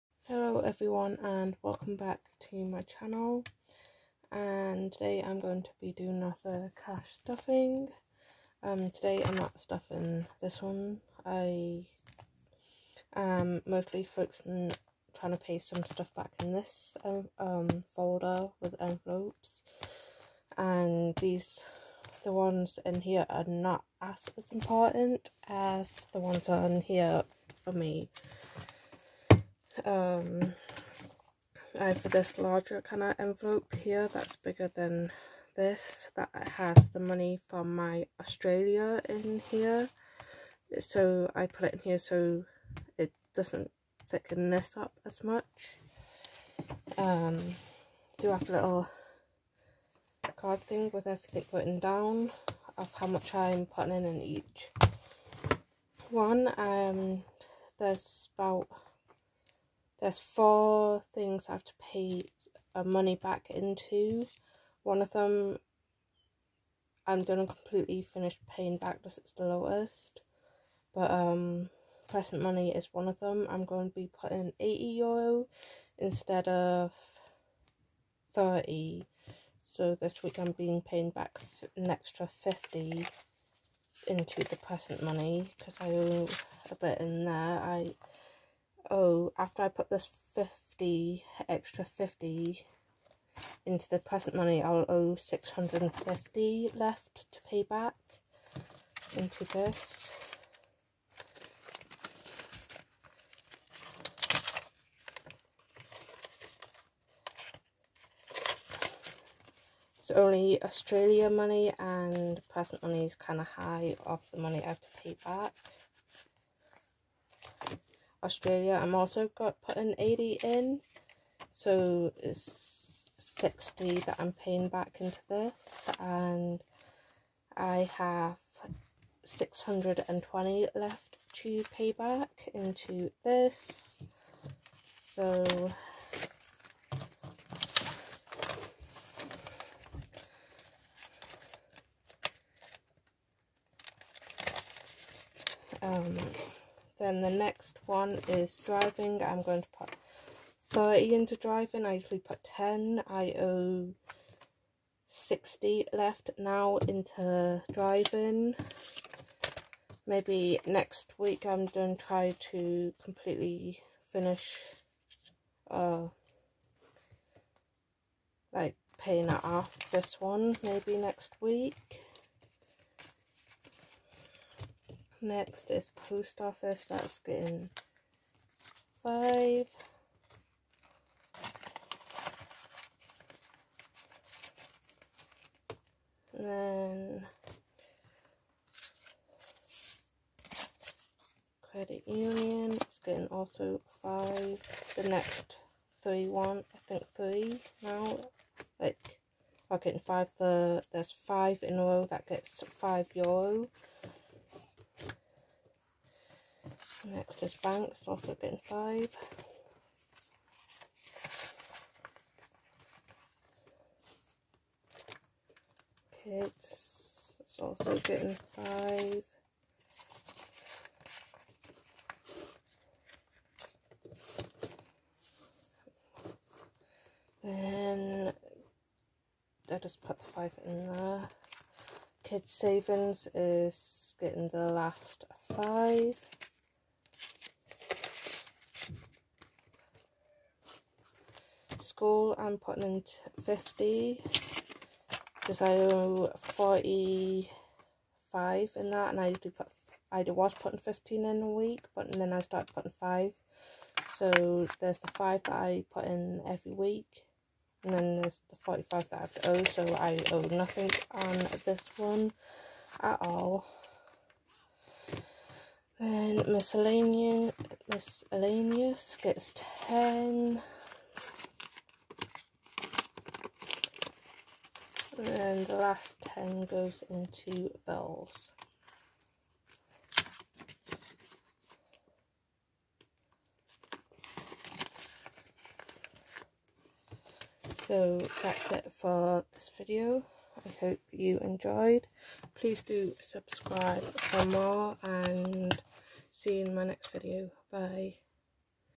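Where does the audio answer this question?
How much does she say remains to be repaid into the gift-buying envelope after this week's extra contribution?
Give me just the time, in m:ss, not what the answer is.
1:35.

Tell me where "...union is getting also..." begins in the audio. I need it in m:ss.
3:12.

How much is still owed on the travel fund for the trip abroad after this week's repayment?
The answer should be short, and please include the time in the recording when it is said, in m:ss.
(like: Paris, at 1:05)
620, at 2:09.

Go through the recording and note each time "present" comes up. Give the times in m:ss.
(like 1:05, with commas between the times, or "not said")
1:12, 1:24, 1:33, 1:52.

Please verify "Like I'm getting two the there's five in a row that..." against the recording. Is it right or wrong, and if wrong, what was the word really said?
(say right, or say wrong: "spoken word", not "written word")
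wrong: "five", not "two".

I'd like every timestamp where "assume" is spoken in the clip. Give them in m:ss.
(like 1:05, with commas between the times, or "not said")
not said.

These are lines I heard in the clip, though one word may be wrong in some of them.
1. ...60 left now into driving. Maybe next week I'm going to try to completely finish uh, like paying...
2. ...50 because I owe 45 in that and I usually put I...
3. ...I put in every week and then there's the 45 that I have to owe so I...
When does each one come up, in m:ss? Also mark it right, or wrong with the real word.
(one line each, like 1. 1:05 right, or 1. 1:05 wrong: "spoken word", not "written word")
1. 2:35 right
2. 4:03 right
3. 4:15 right.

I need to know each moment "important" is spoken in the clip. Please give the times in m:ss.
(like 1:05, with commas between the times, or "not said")
0:24.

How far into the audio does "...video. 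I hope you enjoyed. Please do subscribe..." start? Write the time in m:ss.
4:49.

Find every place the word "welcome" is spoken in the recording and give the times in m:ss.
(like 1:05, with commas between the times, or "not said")
0:01.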